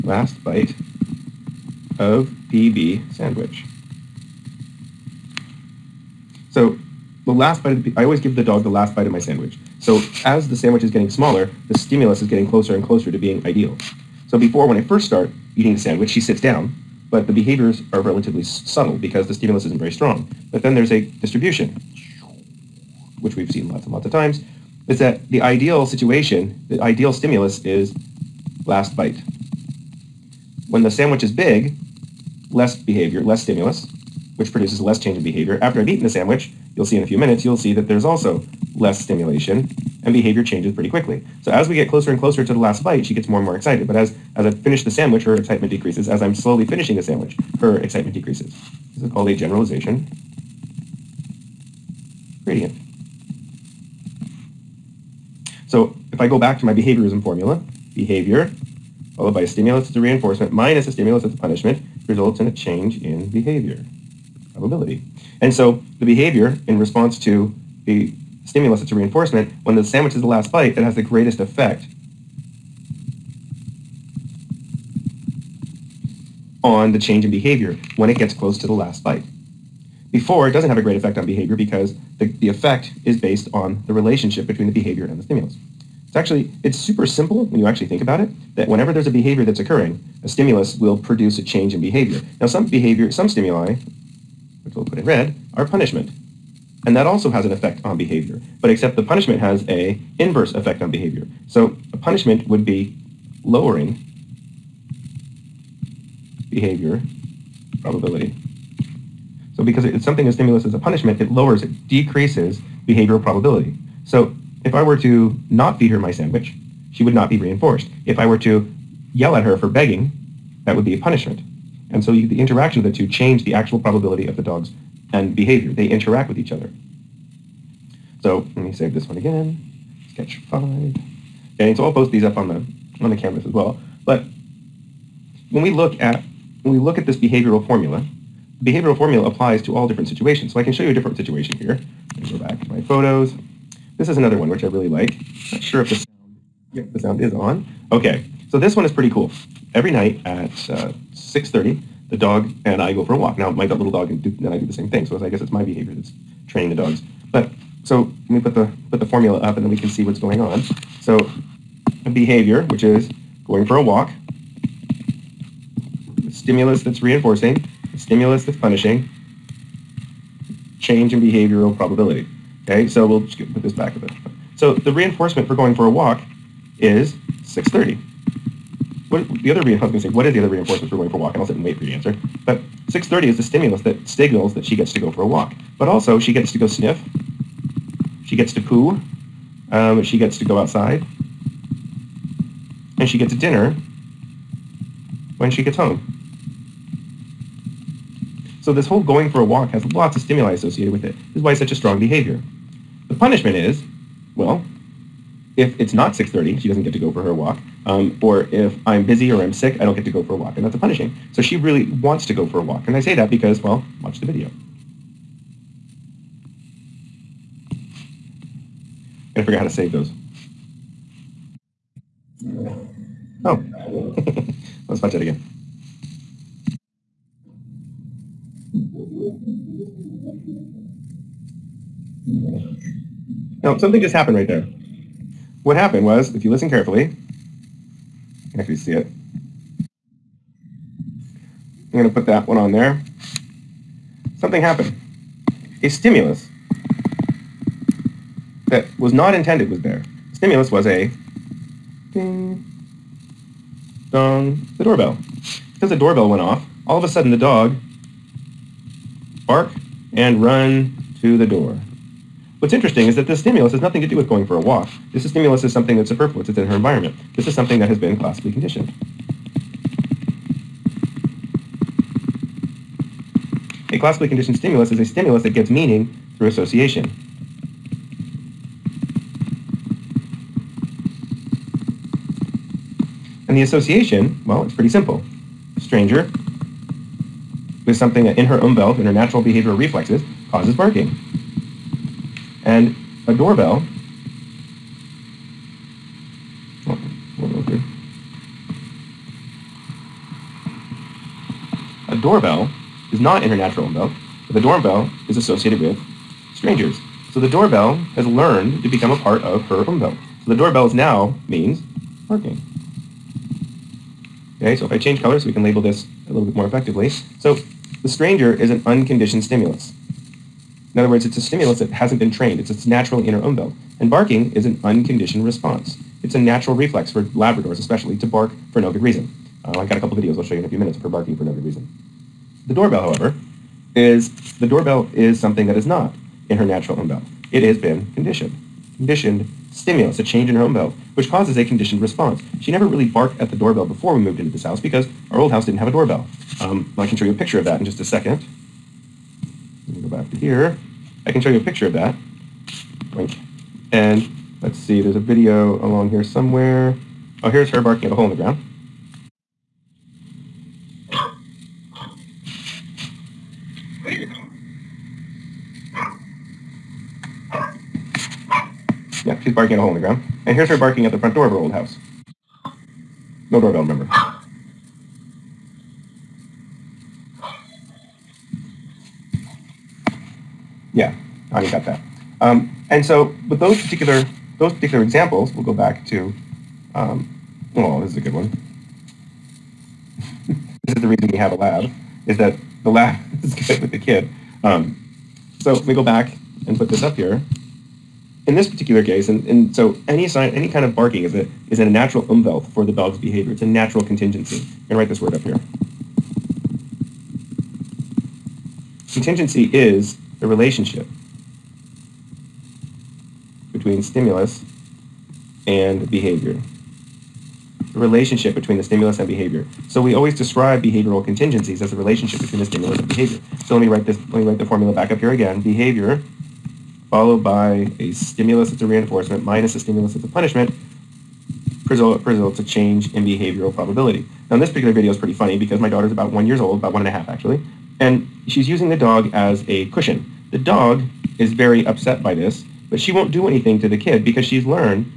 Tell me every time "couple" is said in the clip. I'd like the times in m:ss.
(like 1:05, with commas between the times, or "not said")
5:29.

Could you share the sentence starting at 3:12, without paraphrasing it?
And she gets a dinner when she gets home.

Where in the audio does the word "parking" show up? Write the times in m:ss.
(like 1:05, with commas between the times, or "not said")
5:12.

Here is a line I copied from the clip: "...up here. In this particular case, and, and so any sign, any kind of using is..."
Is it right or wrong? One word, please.
wrong.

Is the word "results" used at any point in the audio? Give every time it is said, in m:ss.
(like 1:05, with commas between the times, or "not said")
1:02, 7:11.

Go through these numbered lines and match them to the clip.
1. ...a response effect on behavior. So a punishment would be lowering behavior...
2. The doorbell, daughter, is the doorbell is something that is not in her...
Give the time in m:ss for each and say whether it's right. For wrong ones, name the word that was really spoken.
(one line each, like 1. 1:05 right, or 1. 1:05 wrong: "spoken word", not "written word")
1. 1:39 wrong: "inverse", not "response"
2. 5:32 wrong: "however", not "daughter".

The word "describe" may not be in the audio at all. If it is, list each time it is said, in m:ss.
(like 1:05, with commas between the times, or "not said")
7:00.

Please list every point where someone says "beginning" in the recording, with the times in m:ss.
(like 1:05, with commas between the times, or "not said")
not said.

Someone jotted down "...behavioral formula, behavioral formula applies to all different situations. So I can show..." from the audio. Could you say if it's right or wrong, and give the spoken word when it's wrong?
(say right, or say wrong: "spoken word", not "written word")
right.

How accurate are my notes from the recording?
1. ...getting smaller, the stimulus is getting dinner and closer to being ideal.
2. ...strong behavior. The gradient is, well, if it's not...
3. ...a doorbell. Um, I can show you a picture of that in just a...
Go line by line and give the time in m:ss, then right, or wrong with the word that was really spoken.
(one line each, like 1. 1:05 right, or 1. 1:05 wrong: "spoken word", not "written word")
1. 0:10 wrong: "closer", not "dinner"
2. 3:21 wrong: "punishment", not "gradient"
3. 5:45 right.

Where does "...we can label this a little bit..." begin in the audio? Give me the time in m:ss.
5:15.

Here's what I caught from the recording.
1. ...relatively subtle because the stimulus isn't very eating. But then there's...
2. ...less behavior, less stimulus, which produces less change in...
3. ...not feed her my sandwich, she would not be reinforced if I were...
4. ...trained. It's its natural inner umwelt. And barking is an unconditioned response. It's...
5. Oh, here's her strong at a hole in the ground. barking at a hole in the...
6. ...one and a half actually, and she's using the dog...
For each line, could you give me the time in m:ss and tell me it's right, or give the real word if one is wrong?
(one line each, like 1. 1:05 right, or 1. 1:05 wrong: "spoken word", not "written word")
1. 0:18 wrong: "strong", not "eating"
2. 0:32 right
3. 1:55 right
4. 5:22 right
5. 5:57 wrong: "barking", not "strong"
6. 7:16 right.